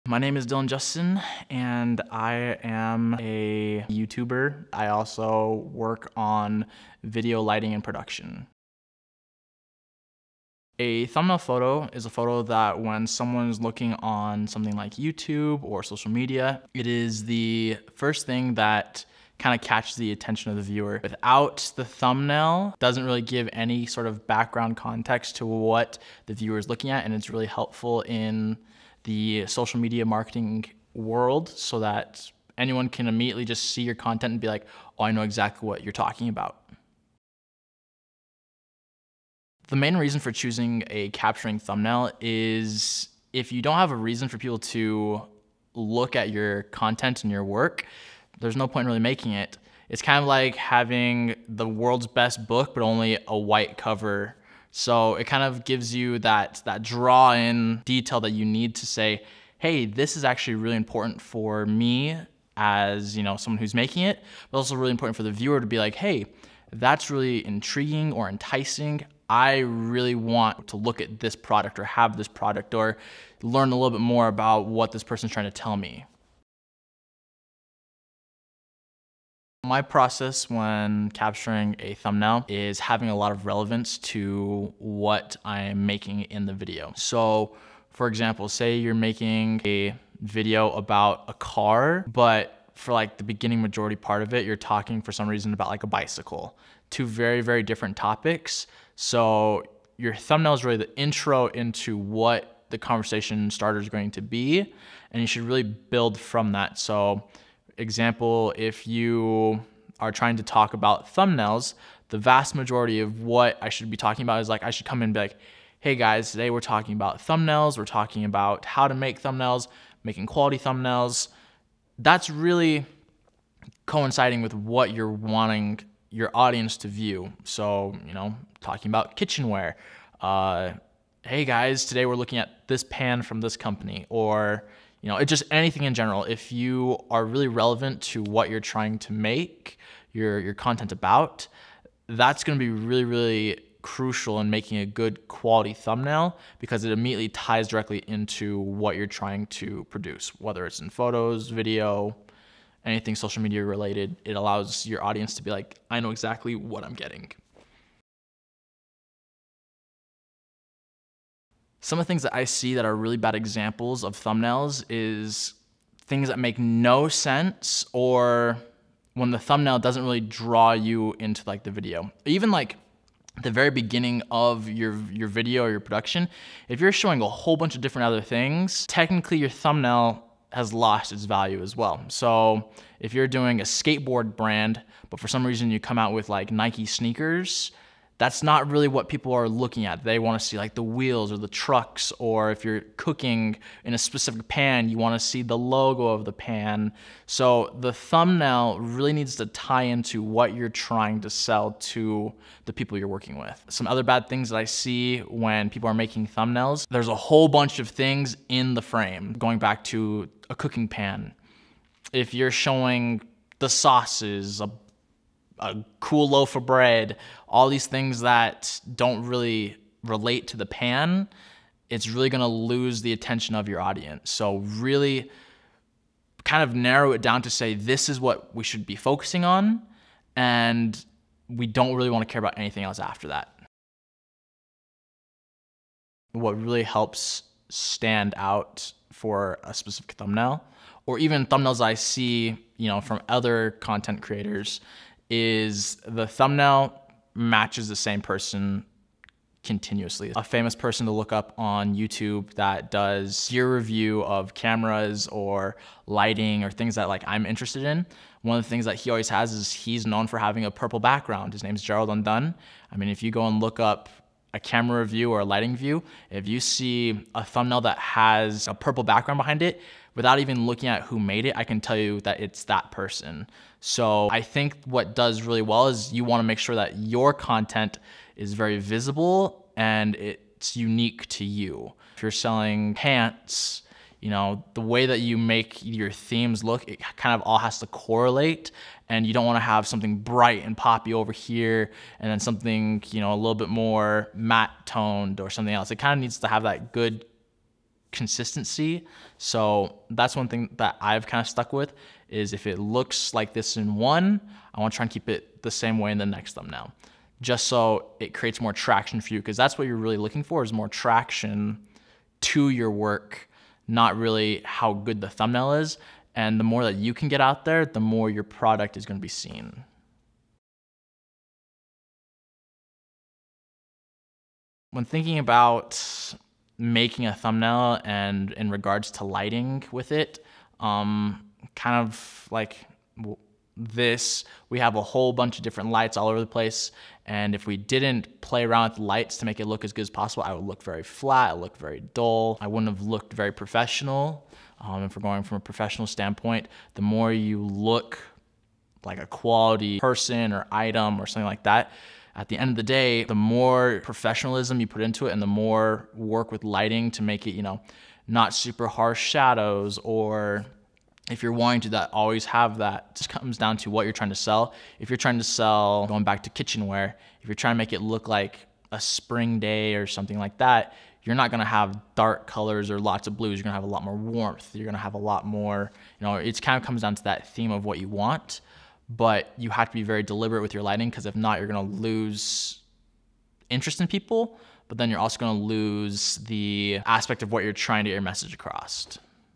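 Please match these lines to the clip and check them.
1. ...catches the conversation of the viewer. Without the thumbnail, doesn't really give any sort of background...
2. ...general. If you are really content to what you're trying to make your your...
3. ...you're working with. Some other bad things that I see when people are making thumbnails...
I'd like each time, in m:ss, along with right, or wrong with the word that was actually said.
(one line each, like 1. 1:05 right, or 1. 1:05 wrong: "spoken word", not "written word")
1. 0:19 wrong: "attention", not "conversation"
2. 2:15 wrong: "relevant", not "content"
3. 3:22 right.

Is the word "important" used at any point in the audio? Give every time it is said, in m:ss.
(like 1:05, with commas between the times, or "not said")
1:00, 1:04.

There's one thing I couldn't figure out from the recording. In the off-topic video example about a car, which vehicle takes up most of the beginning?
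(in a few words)
A bicycle.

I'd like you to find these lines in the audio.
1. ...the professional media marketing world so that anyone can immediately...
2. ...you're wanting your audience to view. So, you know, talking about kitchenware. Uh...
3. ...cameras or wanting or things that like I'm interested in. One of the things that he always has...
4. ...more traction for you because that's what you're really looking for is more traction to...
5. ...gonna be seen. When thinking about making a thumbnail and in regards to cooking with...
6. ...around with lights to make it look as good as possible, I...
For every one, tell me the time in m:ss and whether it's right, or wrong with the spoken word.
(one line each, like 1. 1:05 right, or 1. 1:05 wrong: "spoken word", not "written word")
1. 0:29 wrong: "social", not "professional"
2. 2:04 right
3. 4:14 wrong: "lighting", not "wanting"
4. 5:08 right
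5. 5:19 wrong: "lighting", not "cooking"
6. 5:38 right.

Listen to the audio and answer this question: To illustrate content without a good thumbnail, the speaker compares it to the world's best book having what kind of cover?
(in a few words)
A white cover.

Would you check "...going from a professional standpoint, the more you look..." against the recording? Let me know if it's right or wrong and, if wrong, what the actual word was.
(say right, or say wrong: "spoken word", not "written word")
right.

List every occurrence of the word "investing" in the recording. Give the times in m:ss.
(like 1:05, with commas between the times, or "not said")
not said.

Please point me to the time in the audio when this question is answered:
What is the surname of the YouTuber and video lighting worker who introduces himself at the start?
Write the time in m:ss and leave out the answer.
0:00.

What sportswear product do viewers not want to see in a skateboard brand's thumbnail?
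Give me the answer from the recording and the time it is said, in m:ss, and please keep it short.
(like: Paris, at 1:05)
Nike sneakers, at 3:06.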